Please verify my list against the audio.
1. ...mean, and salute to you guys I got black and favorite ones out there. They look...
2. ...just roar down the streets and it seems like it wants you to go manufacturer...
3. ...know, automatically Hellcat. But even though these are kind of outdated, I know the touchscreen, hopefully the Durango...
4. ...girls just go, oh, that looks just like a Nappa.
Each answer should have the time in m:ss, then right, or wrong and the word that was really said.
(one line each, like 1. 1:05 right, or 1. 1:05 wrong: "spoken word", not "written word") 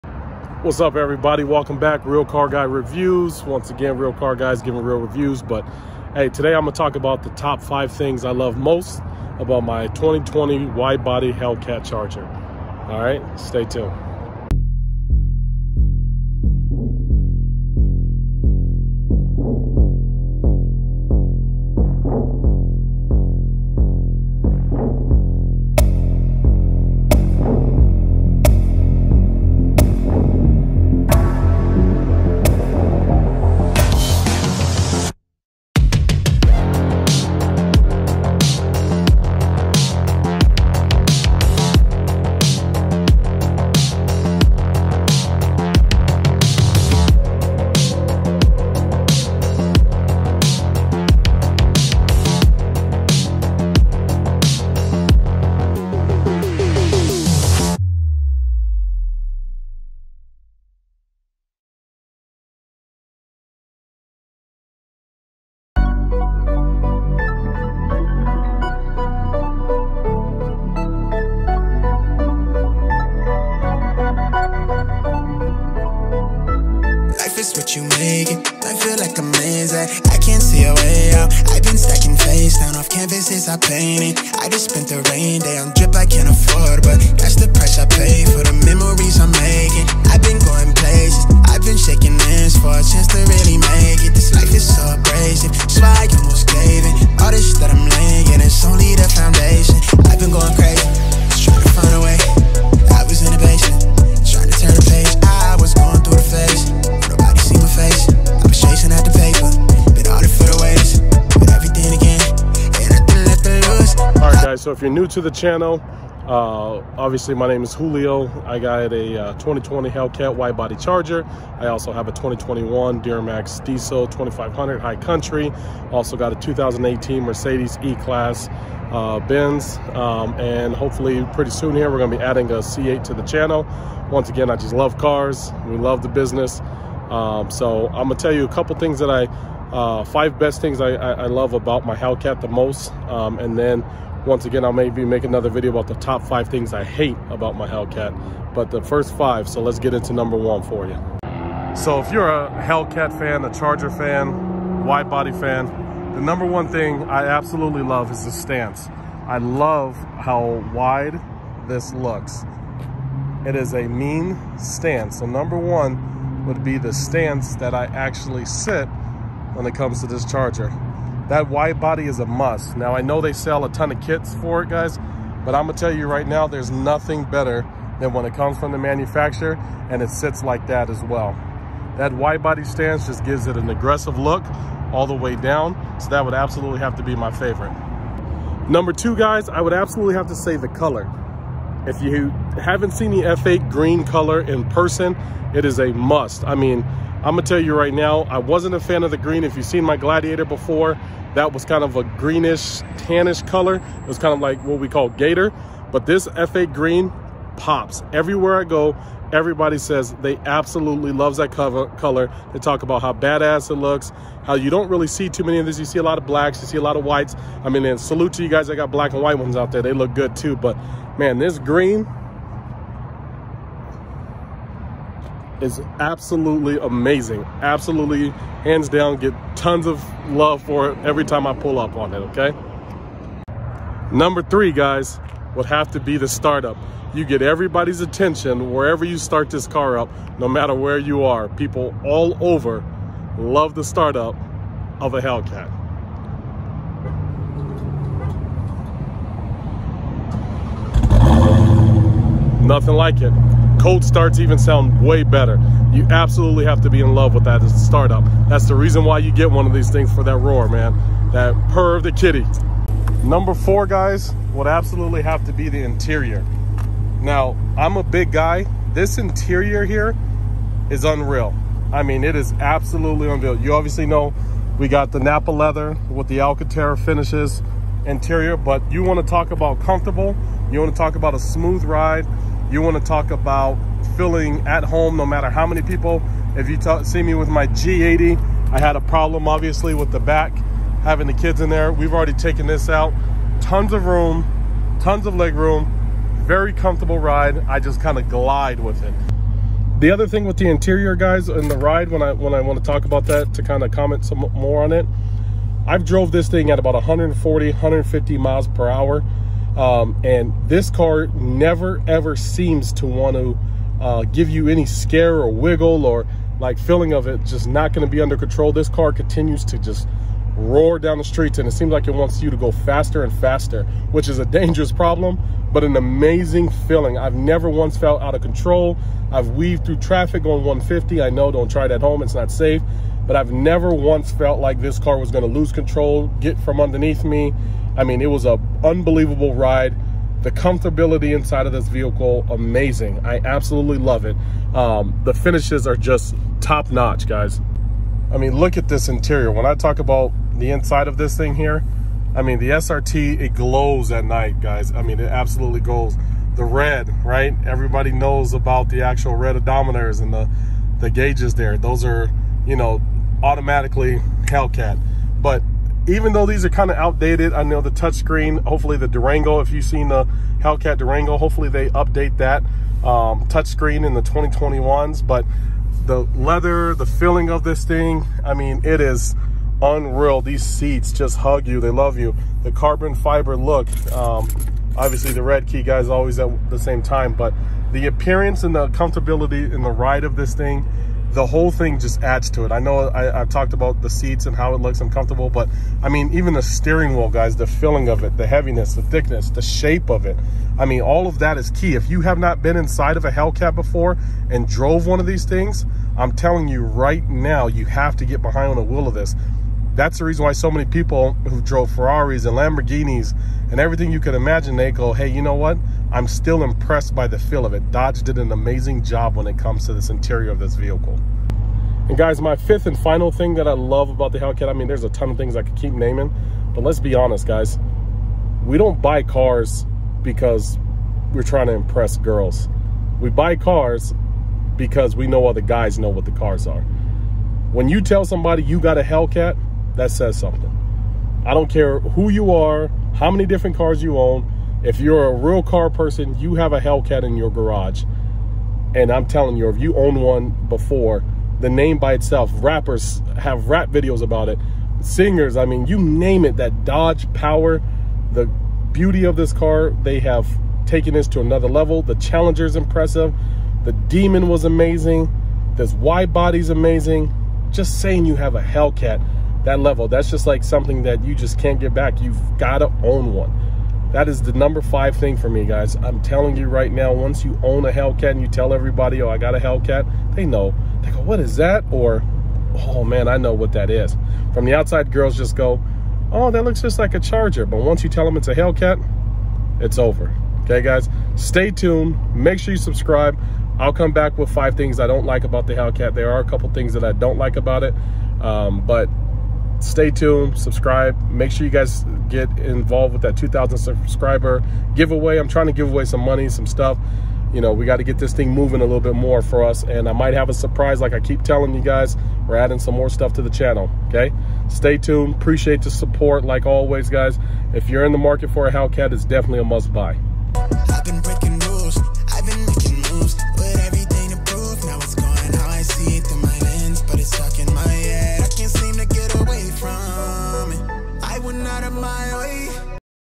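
1. 3:37 wrong: "white", not "favorite"
2. 5:19 wrong: "faster", not "manufacturer"
3. 6:02 right
4. 8:05 wrong: "Charger", not "Nappa".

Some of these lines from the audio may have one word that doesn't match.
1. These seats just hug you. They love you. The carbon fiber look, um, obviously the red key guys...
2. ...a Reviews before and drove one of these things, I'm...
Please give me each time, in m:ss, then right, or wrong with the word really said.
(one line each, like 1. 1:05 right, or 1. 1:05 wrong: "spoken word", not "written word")
1. 6:20 right
2. 6:43 wrong: "Hellcat", not "Reviews".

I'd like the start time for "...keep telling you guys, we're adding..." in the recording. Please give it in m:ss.
8:31.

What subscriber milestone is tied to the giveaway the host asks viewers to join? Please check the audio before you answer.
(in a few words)
2,000.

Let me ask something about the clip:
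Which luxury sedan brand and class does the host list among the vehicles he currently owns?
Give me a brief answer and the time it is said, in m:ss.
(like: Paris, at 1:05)
Mercedes E-Class, at 2:07.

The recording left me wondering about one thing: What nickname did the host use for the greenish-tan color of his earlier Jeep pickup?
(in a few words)
gator.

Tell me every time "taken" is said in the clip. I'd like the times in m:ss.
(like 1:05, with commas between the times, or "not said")
4:52, 7:40.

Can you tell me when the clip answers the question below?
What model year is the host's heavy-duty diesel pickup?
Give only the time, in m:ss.
2:02.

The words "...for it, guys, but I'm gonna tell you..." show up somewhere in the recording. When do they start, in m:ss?
2:54.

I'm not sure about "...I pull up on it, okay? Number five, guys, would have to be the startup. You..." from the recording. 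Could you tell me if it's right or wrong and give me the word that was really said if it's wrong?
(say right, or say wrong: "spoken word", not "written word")
wrong: "three", not "five".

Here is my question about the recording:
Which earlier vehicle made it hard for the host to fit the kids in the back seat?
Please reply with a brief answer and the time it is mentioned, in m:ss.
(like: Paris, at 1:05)
G80, at 4:47.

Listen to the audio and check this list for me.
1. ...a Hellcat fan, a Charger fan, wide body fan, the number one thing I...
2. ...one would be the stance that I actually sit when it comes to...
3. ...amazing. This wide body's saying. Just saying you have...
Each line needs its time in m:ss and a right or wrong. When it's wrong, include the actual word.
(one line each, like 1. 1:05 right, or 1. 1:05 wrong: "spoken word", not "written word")
1. 2:32 right
2. 2:45 right
3. 7:44 wrong: "amazing", not "saying".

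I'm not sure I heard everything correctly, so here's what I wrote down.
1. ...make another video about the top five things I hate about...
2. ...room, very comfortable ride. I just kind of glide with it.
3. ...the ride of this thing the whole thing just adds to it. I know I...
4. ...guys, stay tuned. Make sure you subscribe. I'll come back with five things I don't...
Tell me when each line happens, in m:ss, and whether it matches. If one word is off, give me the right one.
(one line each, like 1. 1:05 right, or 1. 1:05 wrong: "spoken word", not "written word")
1. 2:25 right
2. 4:55 right
3. 6:29 right
4. 8:10 right.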